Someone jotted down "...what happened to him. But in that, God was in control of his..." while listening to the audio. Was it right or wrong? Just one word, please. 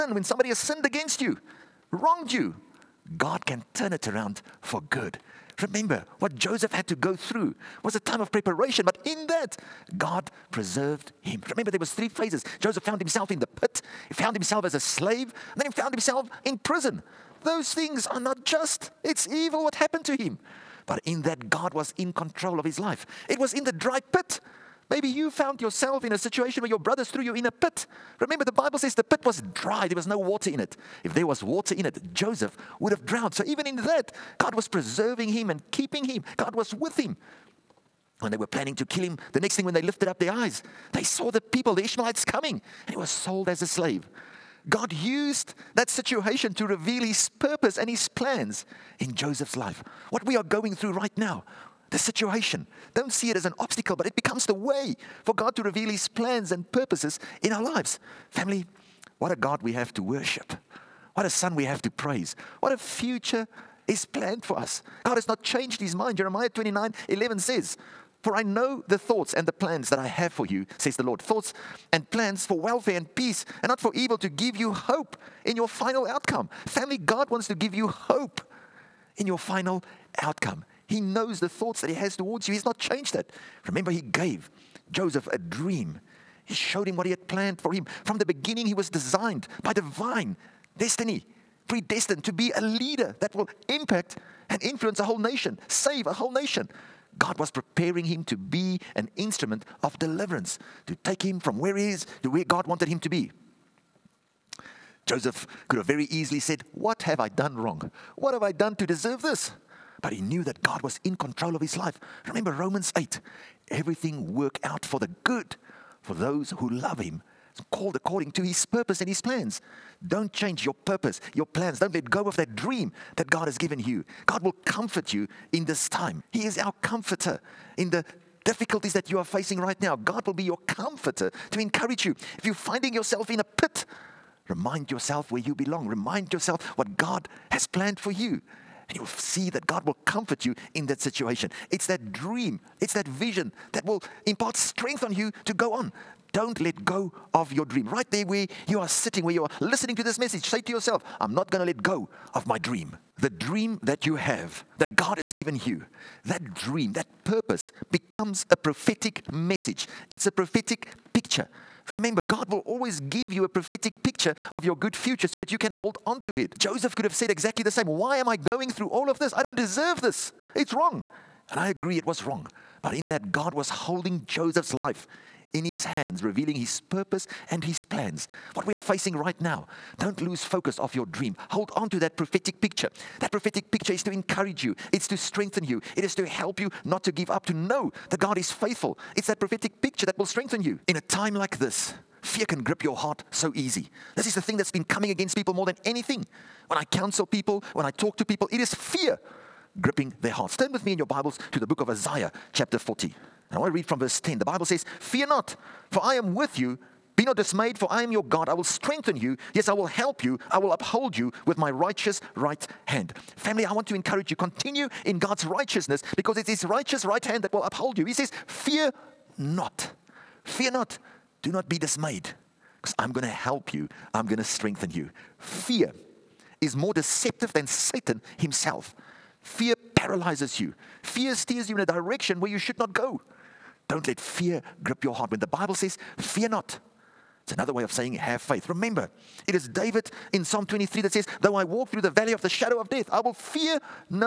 right.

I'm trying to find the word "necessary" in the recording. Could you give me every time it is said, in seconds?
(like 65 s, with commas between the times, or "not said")
not said.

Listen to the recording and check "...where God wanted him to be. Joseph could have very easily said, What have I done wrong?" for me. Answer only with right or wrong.
right.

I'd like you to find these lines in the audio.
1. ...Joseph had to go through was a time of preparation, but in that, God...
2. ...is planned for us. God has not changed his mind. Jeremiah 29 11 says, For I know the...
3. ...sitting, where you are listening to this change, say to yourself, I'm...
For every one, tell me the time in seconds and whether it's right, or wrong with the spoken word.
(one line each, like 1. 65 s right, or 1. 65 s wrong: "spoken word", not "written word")
1. 6 s right
2. 63 s right
3. 148 s wrong: "message", not "change".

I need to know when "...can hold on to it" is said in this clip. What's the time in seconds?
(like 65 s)
165 s.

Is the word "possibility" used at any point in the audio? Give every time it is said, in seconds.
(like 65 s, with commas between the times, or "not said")
not said.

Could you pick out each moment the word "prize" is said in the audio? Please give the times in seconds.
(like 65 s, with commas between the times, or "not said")
not said.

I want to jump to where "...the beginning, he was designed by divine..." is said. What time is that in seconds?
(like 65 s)
88 s.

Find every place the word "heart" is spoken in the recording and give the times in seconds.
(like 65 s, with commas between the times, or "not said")
192 s, 200 s, 235 s.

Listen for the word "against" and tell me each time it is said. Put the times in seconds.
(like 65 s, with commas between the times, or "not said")
0 s, 195 s.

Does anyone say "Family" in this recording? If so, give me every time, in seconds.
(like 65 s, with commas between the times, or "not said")
58 s, 76 s, 213 s.